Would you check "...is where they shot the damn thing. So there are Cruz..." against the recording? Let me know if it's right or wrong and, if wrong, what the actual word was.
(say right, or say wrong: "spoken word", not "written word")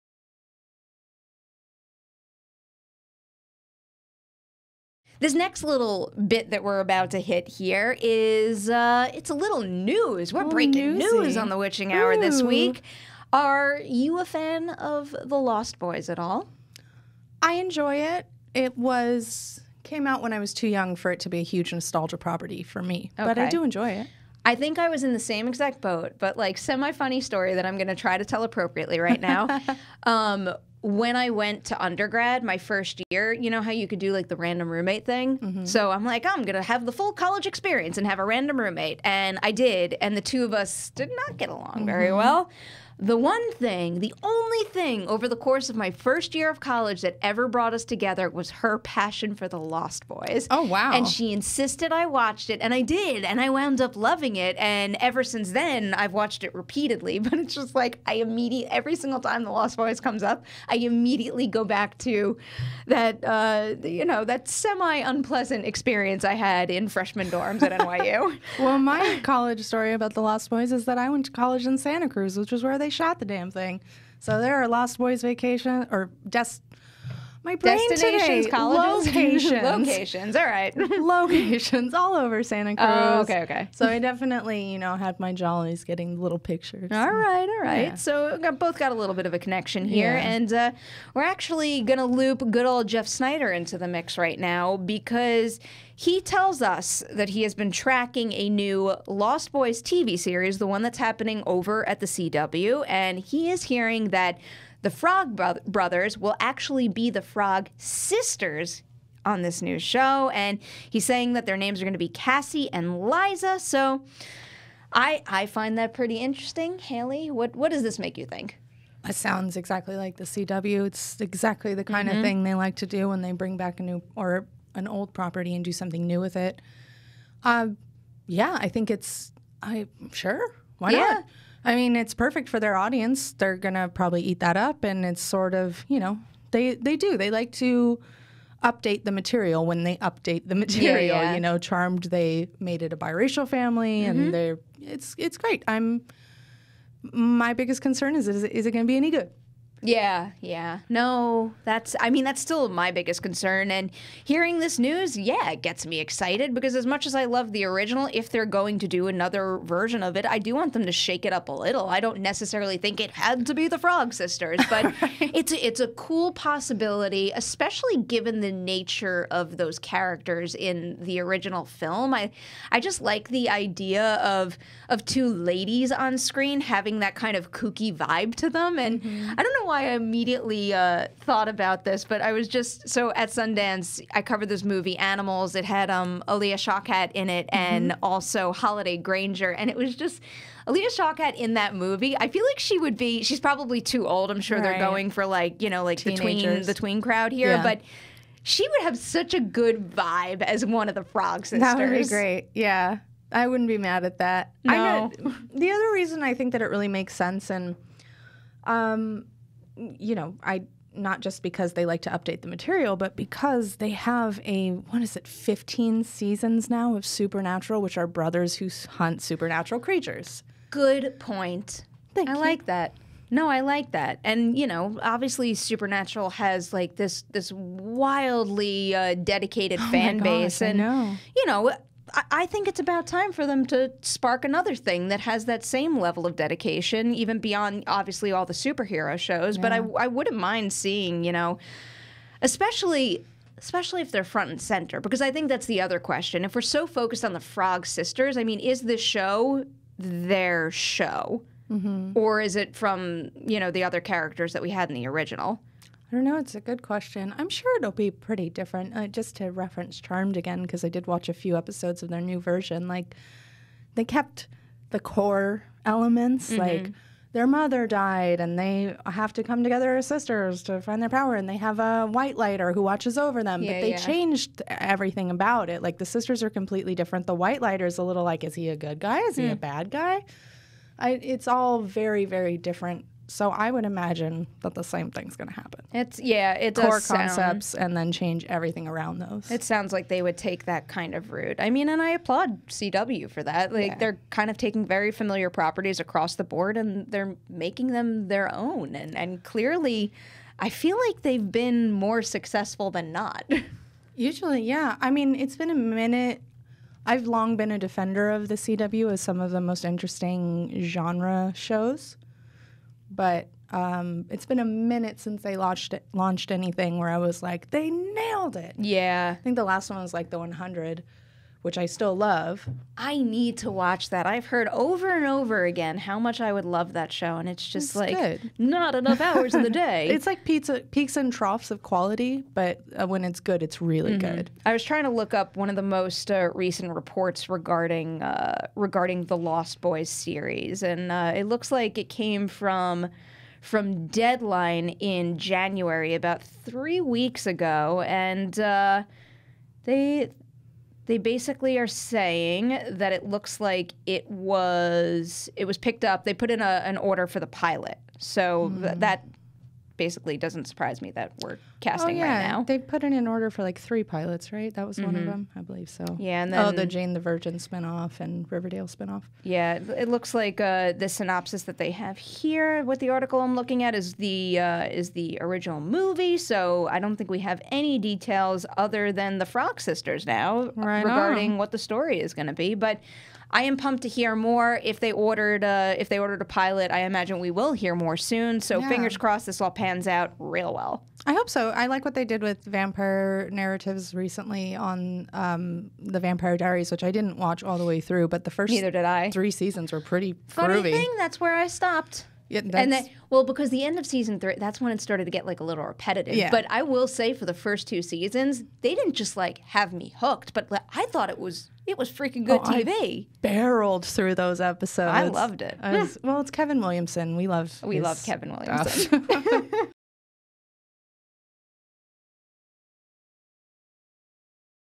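wrong: "Lost", not "Cruz".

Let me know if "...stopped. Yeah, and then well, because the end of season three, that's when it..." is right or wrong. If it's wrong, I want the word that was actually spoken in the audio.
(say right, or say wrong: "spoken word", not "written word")
right.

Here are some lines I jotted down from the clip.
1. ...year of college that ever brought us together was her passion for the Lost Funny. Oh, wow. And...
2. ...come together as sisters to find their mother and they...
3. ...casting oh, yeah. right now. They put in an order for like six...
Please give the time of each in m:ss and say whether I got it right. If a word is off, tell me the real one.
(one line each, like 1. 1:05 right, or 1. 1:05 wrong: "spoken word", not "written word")
1. 0:46 wrong: "Boys", not "Funny"
2. 4:29 wrong: "power", not "mother"
3. 6:01 wrong: "three", not "six".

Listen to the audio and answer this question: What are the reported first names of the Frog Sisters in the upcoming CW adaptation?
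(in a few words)
Cassie and Liza.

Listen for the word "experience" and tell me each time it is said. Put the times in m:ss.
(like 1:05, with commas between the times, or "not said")
0:37, 1:05.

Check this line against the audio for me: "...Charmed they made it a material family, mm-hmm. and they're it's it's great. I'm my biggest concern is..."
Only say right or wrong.
wrong.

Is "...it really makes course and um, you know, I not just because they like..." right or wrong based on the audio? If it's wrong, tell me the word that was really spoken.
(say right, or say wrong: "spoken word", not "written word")
wrong: "sense", not "course".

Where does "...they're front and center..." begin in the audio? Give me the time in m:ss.
4:04.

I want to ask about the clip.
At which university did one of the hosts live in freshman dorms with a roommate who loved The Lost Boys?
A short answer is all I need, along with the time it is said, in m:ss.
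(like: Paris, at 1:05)
NYU, at 1:07.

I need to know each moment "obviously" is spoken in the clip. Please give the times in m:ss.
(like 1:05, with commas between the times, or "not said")
3:45, 3:57.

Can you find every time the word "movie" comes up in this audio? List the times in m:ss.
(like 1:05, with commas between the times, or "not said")
3:04, 3:11, 6:15.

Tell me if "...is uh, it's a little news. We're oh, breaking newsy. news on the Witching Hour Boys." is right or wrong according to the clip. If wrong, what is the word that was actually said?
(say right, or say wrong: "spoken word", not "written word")
wrong: "Ooh", not "Boys".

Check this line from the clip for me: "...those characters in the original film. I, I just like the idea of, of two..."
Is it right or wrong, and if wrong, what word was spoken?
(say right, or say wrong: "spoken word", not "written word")
right.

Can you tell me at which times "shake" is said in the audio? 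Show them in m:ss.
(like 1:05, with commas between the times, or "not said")
2:40.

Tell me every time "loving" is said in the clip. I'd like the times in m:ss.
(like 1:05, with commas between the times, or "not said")
0:53.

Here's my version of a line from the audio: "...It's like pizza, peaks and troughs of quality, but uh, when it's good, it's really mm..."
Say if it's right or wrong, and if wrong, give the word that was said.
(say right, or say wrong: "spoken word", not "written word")
right.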